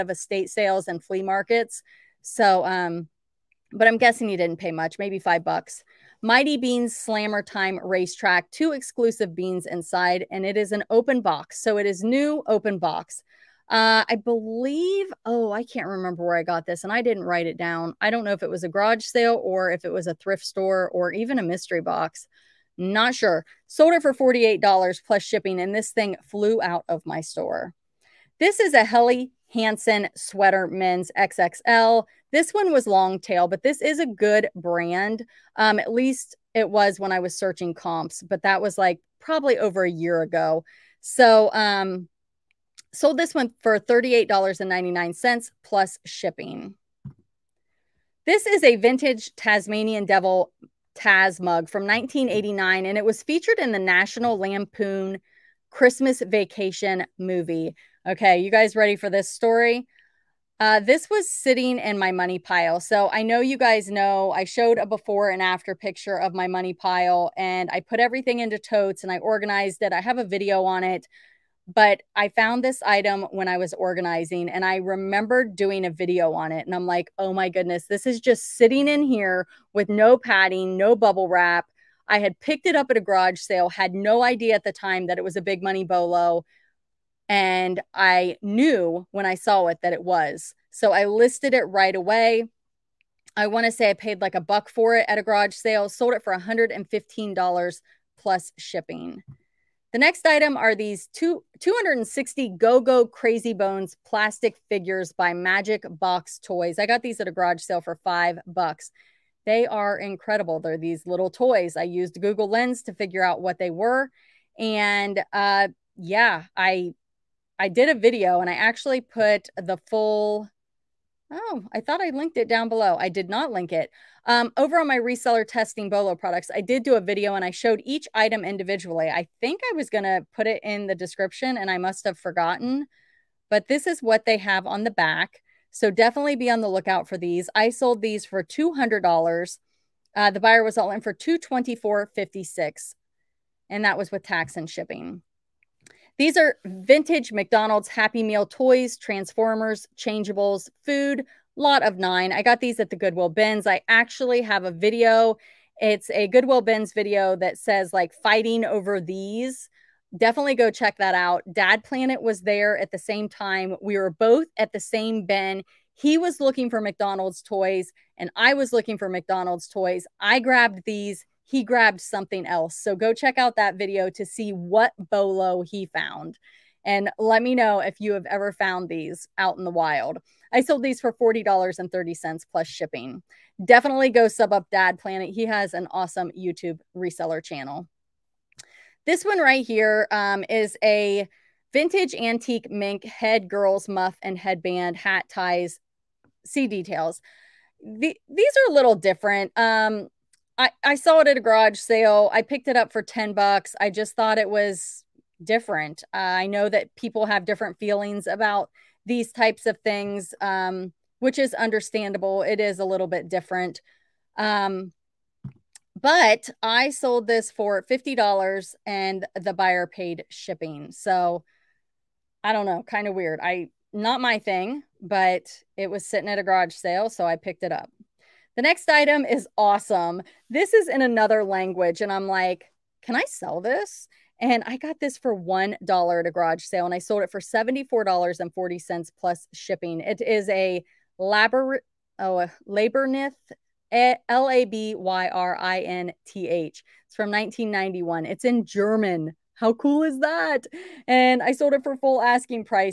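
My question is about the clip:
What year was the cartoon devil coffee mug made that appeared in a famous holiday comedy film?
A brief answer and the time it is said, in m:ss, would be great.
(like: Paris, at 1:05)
1989, at 0:51.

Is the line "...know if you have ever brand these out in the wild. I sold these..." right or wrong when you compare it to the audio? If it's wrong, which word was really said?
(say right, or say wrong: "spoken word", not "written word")
wrong: "found", not "brand".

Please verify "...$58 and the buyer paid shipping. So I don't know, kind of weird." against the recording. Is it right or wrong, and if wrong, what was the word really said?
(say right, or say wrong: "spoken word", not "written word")
wrong: "50", not "58".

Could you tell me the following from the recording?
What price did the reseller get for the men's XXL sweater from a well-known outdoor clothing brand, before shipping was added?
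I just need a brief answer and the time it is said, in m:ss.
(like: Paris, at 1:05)
$38.99, at 0:43.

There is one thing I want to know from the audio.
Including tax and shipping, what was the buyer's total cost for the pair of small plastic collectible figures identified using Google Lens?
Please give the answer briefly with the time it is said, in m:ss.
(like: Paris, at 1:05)
$224.56, at 2:21.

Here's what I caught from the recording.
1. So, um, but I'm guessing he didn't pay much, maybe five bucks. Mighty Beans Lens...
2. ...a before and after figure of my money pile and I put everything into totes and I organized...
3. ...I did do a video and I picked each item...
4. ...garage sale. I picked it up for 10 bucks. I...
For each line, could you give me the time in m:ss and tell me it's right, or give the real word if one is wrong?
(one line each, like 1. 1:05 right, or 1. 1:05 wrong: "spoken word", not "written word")
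1. 0:02 wrong: "Slammer", not "Lens"
2. 1:04 wrong: "picture", not "figure"
3. 2:06 wrong: "showed", not "picked"
4. 3:21 right.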